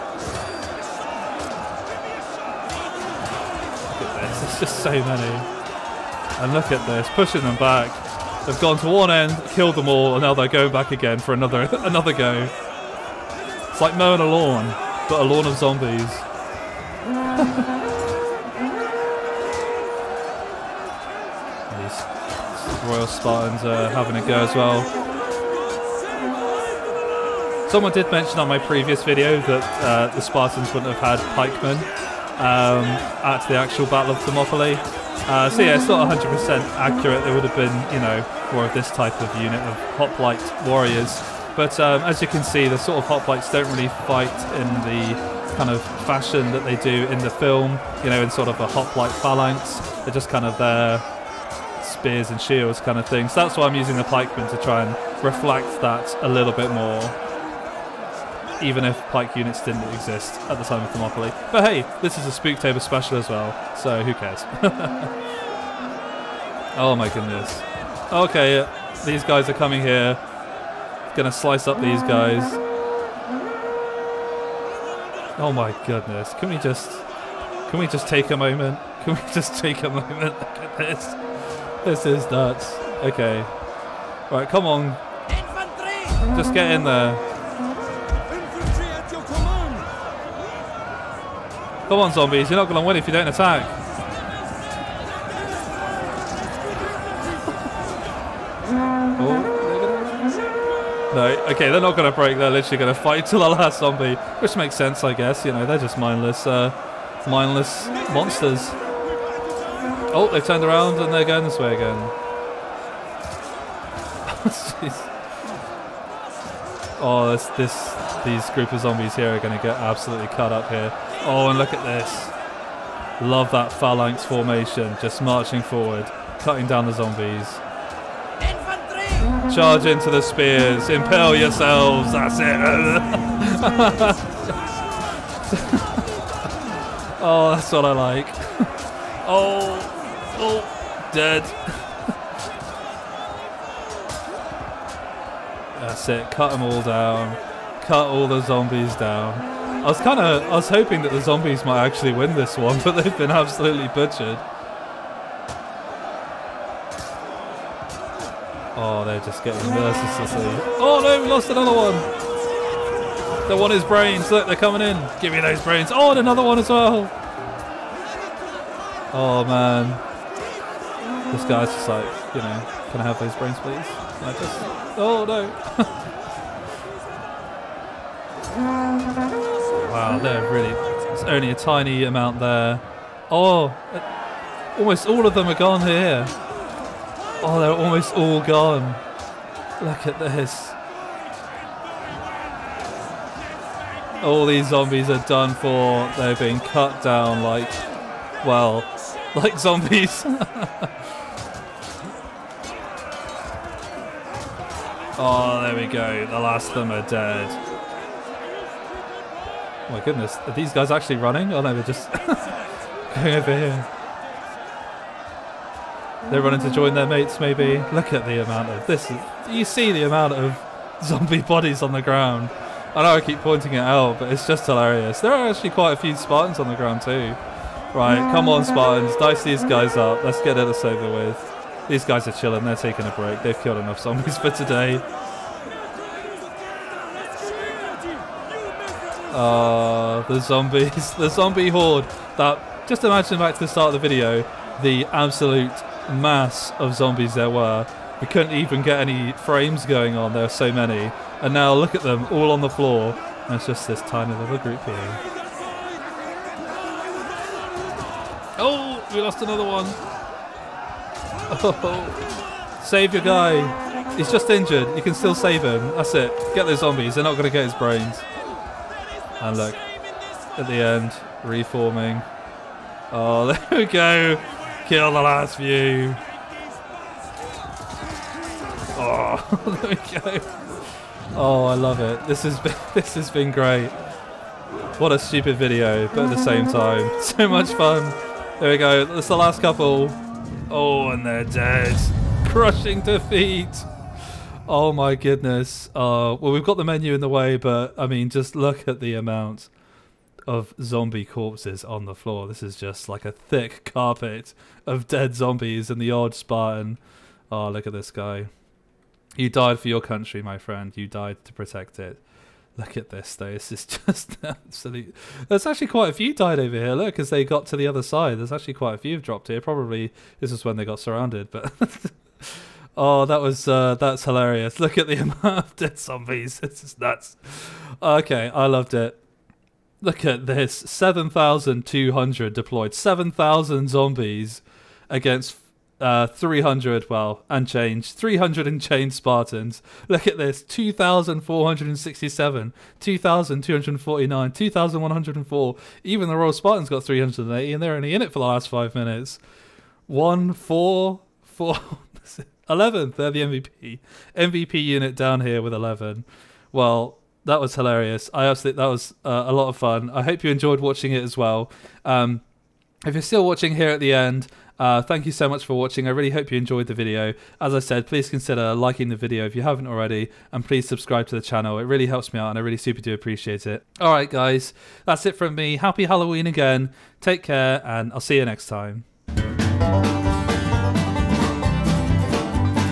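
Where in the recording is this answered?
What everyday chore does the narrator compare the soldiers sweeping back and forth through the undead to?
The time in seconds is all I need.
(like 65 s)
13 s.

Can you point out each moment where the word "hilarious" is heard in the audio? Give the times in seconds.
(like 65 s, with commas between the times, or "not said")
224 s, 324 s, 357 s.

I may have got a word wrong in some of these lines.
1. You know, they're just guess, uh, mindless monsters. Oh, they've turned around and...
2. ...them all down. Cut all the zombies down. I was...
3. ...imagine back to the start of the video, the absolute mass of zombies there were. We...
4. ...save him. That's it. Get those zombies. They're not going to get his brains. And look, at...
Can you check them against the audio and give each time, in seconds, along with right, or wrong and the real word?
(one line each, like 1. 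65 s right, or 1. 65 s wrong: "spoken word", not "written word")
1. 105 s wrong: "mindless", not "guess"
2. 146 s right
3. 243 s right
4. 265 s right.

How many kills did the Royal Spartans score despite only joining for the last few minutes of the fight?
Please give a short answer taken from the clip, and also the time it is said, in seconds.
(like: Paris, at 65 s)
380, at 347 s.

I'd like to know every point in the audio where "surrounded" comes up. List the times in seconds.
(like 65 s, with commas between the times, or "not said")
320 s.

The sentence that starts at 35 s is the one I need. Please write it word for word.
Uh, so yeah, it's not 100% accurate.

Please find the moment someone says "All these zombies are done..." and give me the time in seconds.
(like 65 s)
194 s.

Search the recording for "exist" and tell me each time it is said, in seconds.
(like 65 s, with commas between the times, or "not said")
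59 s.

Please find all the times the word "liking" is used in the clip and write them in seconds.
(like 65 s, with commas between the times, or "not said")
368 s.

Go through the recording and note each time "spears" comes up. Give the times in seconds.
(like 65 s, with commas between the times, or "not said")
51 s, 130 s.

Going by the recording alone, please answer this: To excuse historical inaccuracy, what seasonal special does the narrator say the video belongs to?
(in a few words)
Spooktober special.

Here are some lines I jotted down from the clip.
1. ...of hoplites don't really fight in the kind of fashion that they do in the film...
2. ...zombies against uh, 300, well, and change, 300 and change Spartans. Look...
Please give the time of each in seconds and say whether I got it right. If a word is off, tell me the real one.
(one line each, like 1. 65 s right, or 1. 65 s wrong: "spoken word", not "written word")
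1. 42 s right
2. 333 s right.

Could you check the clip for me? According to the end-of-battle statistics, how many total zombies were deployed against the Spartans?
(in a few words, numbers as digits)
7,200.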